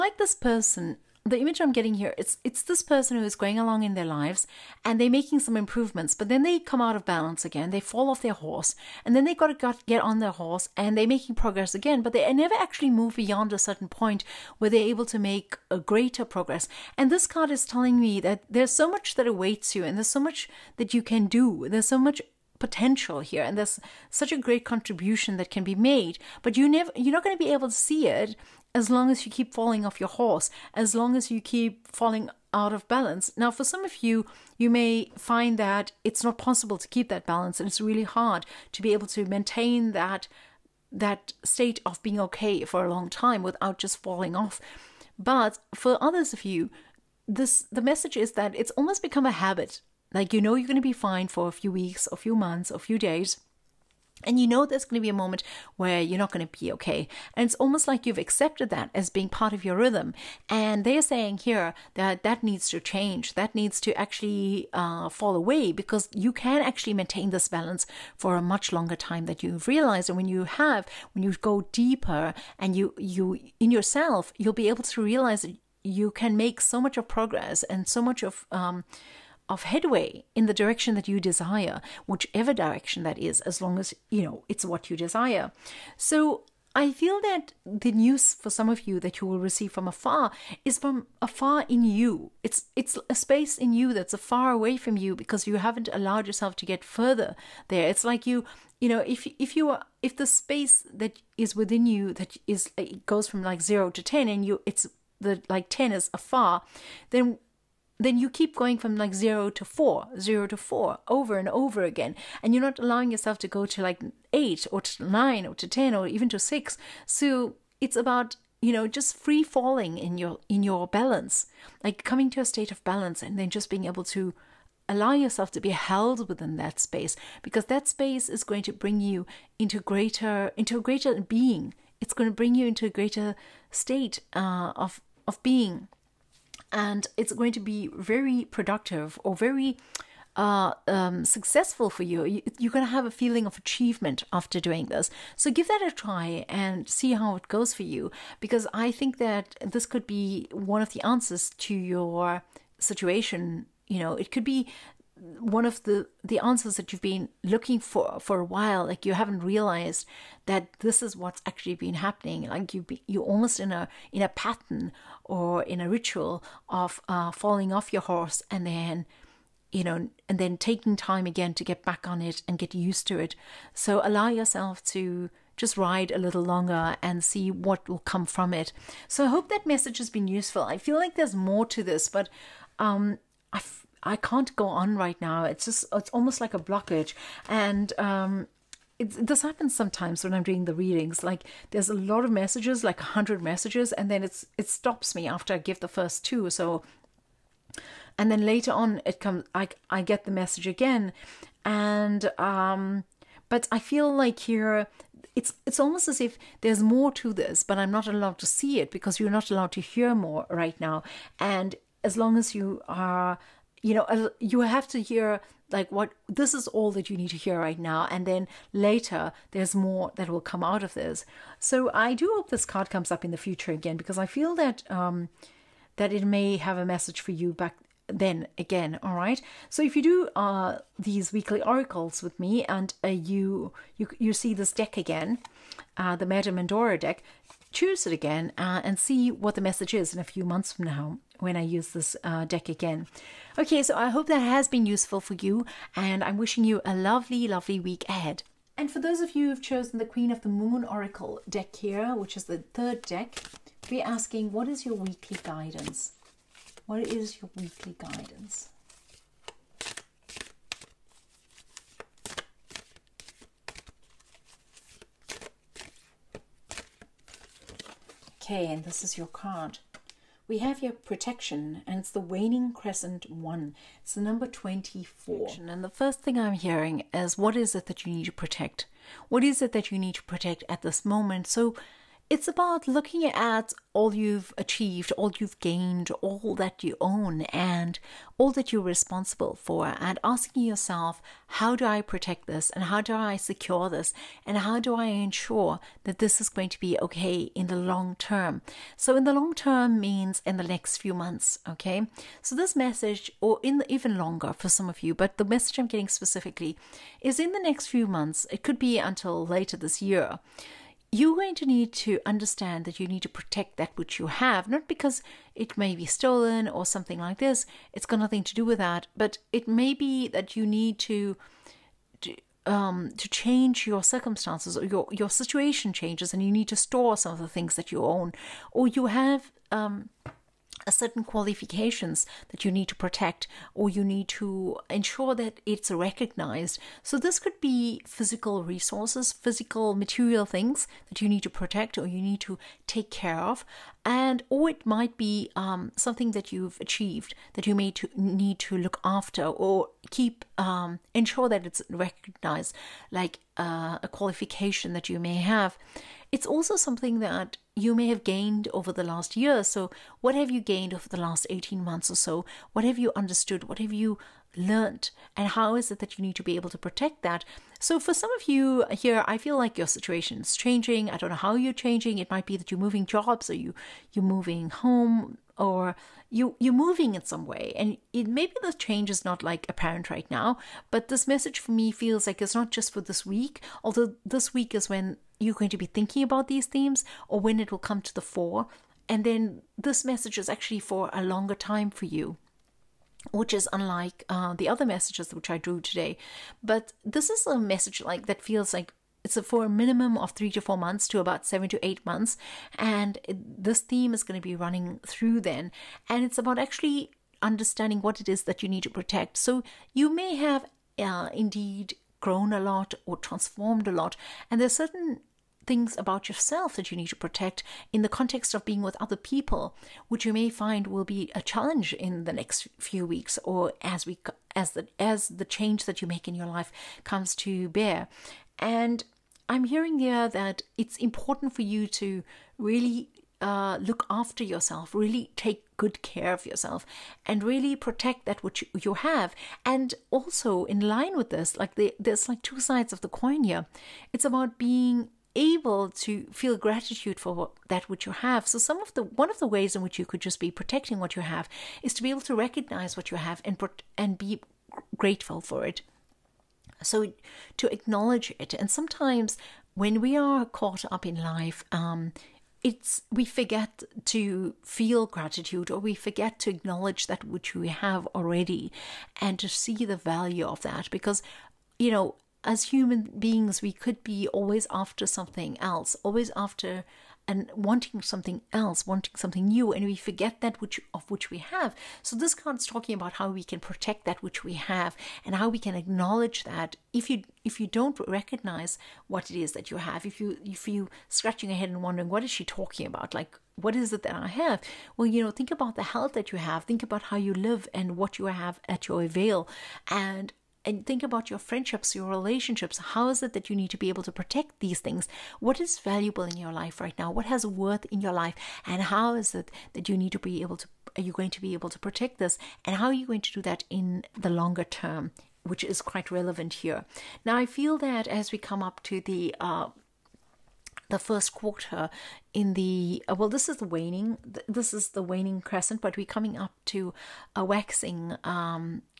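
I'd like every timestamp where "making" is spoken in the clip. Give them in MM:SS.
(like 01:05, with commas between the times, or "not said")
00:05, 00:11.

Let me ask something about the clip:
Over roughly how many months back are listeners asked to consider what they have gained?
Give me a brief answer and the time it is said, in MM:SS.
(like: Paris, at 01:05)
18, at 06:01.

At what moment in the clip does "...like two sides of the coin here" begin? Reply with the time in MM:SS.
07:22.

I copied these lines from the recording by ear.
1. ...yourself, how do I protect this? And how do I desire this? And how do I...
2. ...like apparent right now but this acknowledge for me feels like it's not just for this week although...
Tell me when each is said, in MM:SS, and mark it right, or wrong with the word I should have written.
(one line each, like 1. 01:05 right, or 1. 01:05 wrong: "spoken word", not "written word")
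1. 04:50 wrong: "secure", not "desire"
2. 06:19 wrong: "message", not "acknowledge".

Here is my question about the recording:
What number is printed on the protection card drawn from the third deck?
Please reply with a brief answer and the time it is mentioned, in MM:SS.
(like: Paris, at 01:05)
24, at 04:34.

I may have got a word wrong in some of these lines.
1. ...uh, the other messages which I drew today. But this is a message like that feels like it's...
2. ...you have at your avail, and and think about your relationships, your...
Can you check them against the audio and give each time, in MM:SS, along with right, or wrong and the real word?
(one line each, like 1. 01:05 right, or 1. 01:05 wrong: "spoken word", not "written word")
1. 06:34 right
2. 08:18 wrong: "friendships", not "relationships".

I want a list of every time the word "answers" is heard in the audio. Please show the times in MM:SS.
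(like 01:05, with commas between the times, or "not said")
02:31, 02:36.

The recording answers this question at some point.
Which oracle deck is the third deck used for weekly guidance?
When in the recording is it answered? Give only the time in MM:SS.
04:10.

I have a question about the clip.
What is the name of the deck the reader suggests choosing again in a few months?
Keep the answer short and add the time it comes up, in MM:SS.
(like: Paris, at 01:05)
Madame Endora, at 03:56.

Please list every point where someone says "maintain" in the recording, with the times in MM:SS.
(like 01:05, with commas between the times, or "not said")
00:39, 01:06.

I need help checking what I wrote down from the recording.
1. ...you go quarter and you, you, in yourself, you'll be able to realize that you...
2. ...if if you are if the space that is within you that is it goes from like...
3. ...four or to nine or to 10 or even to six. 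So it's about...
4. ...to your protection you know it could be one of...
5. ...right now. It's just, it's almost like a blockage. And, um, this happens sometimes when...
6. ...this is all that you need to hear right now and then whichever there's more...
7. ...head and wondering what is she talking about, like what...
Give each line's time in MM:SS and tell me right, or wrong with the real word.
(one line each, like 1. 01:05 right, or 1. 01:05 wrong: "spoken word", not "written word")
1. 01:11 wrong: "deeper", not "quarter"
2. 01:39 right
3. 01:54 wrong: "eight", not "four"
4. 02:31 wrong: "situation", not "protection"
5. 03:04 right
6. 03:36 wrong: "later", not "whichever"
7. 08:11 right.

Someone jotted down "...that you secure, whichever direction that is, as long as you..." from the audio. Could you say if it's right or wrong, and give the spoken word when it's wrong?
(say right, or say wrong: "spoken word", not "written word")
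wrong: "desire", not "secure".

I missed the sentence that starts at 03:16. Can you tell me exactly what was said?
So, and then later on it comes.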